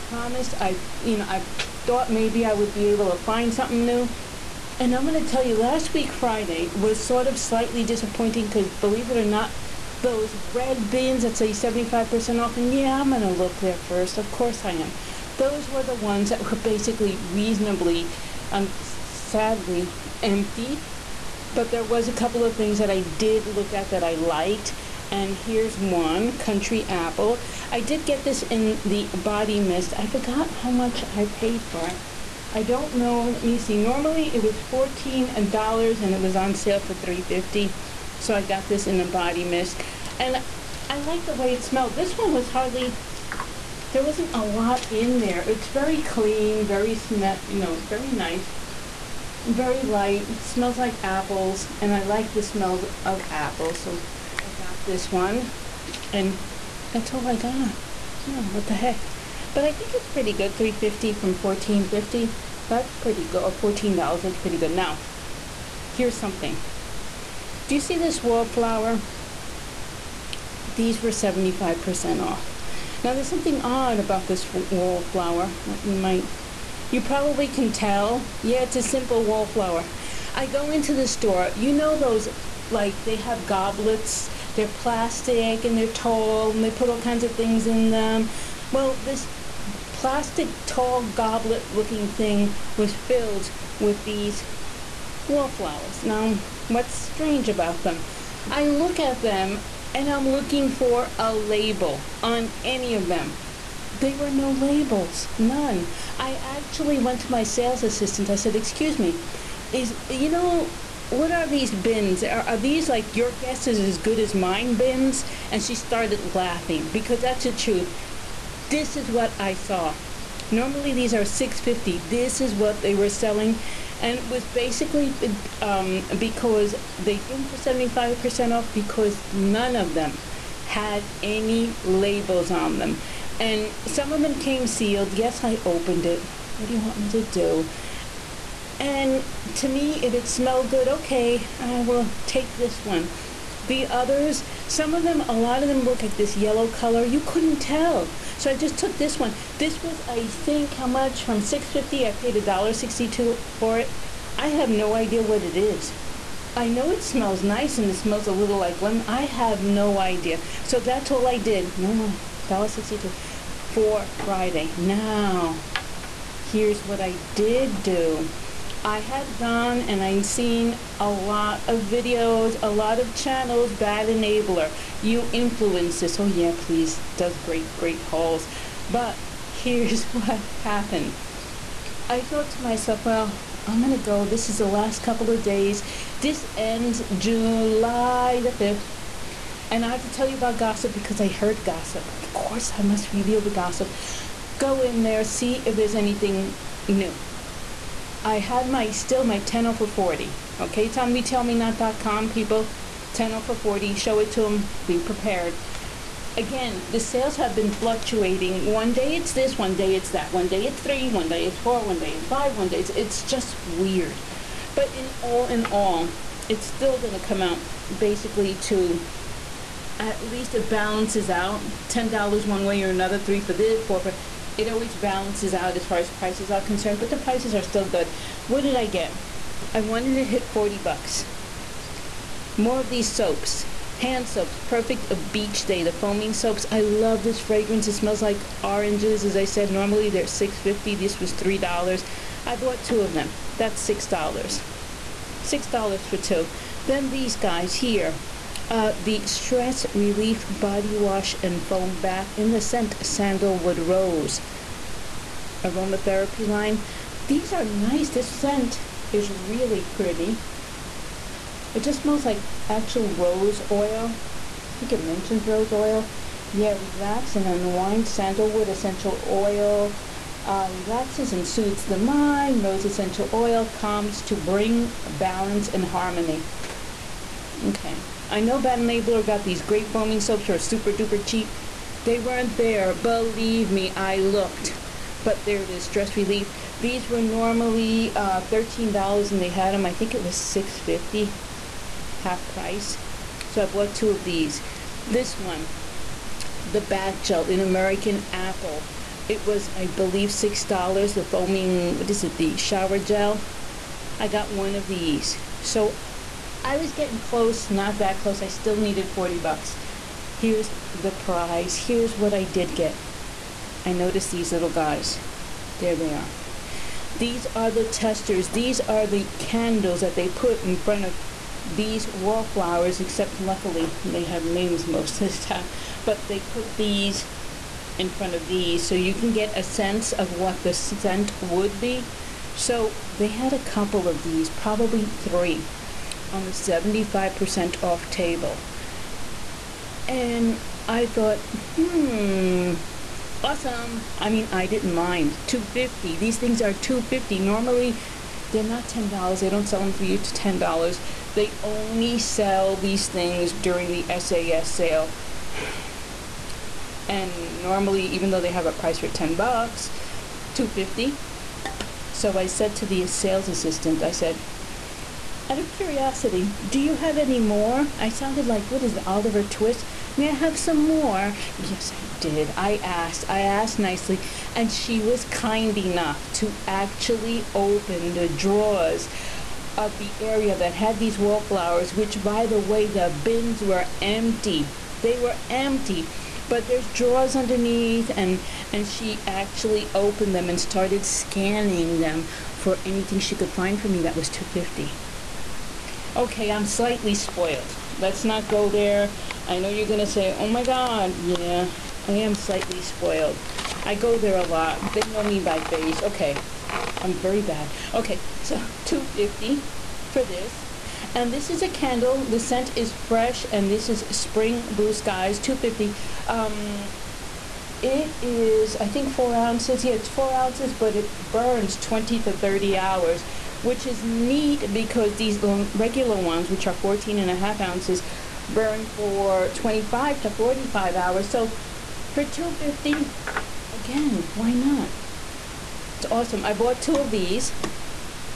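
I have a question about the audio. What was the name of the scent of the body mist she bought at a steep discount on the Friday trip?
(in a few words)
Country Apple.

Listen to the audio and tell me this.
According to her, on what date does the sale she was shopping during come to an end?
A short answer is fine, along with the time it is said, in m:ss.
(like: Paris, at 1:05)
July 5th, at 3:07.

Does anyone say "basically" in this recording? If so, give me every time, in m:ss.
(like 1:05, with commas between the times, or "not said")
0:16, 2:04, 3:37.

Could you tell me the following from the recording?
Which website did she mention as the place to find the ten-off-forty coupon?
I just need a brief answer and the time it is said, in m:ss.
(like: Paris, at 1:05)
retailmenot.com, at 3:21.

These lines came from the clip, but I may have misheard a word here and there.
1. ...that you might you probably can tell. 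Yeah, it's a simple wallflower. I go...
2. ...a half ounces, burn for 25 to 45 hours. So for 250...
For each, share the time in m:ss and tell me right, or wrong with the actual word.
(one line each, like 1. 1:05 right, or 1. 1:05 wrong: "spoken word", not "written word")
1. 1:15 right
2. 7:07 right.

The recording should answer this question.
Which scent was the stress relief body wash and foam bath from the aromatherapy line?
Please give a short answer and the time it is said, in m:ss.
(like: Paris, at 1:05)
Sandalwood Rose, at 4:13.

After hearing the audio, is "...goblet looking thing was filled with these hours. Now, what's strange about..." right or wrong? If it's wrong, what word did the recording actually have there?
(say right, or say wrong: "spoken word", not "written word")
wrong: "wallflowers", not "hours".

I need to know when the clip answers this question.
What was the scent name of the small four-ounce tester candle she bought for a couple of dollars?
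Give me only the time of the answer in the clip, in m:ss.
6:54.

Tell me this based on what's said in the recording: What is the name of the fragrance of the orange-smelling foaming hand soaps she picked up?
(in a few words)
A Beach Day.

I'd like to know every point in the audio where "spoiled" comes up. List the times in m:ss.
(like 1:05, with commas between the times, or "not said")
6:37, 6:42.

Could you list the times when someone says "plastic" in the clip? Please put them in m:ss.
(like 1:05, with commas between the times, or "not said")
1:24, 1:29.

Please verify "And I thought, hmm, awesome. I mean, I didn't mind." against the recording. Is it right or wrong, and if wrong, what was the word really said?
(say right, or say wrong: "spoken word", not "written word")
right.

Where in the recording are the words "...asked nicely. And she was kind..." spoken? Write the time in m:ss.
6:13.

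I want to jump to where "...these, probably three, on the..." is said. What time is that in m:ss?
5:34.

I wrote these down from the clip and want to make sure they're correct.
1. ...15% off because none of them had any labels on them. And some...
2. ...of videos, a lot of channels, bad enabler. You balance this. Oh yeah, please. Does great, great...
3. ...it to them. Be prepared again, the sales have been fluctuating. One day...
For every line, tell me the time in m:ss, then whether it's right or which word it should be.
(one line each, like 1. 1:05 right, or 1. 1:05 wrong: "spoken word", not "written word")
1. 2:07 wrong: "75", not "15"
2. 2:51 wrong: "influence", not "balance"
3. 3:24 right.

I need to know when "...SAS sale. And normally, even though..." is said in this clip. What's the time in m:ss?
5:54.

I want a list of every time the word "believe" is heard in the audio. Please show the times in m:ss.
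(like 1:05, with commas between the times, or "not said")
0:08, 4:42, 4:59.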